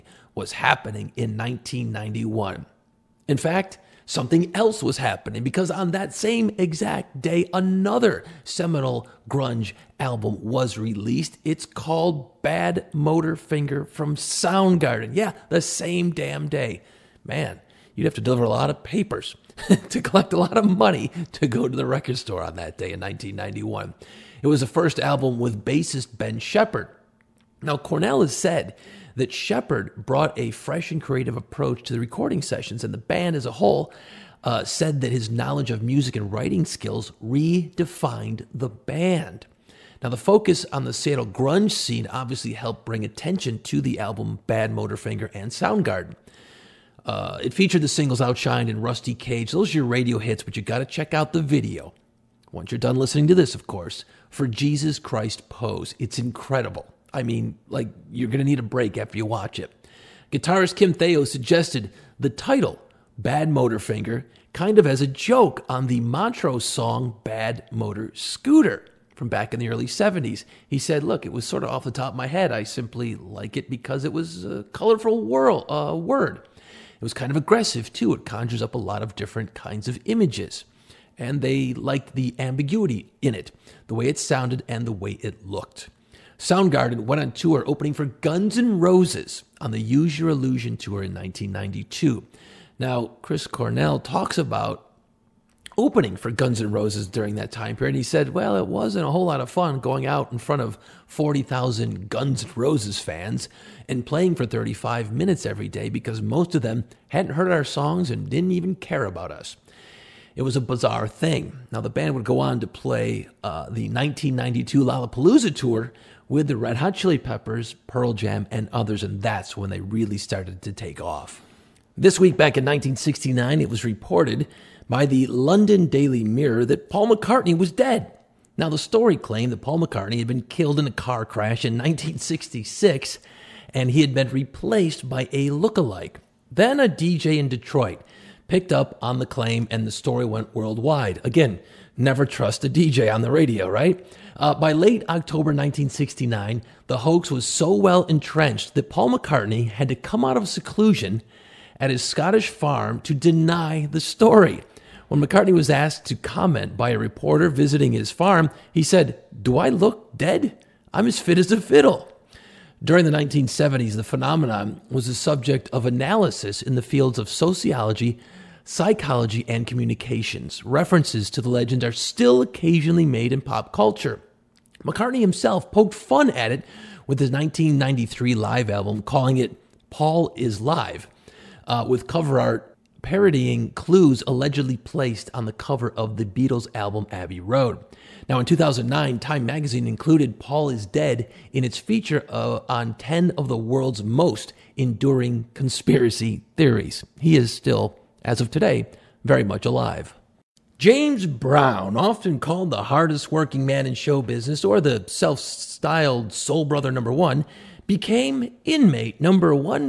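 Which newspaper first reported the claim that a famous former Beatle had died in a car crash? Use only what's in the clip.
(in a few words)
London Daily Mirror.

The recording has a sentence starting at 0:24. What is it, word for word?
It was the first album with bassist Ben Shepherd.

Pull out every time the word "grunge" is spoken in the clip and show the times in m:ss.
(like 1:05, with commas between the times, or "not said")
0:09, 0:41.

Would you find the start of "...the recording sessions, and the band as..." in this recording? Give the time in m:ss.
0:31.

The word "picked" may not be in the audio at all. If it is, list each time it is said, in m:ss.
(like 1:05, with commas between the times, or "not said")
2:18.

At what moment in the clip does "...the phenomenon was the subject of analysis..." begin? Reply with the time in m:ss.
2:43.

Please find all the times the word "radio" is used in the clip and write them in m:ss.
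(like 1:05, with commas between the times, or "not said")
0:49, 2:23.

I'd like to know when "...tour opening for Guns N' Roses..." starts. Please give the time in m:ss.
1:27.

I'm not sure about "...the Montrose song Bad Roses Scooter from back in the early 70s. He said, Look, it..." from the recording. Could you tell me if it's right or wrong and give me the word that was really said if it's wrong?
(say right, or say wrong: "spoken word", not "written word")
wrong: "Motor", not "Roses".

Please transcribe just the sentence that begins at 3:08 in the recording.
Now, in 2009, Time magazine included Paul is Dead in its feature uh, on 10 of the world's most enduring conspiracy theories.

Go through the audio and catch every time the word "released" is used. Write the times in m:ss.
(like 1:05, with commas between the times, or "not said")
0:10.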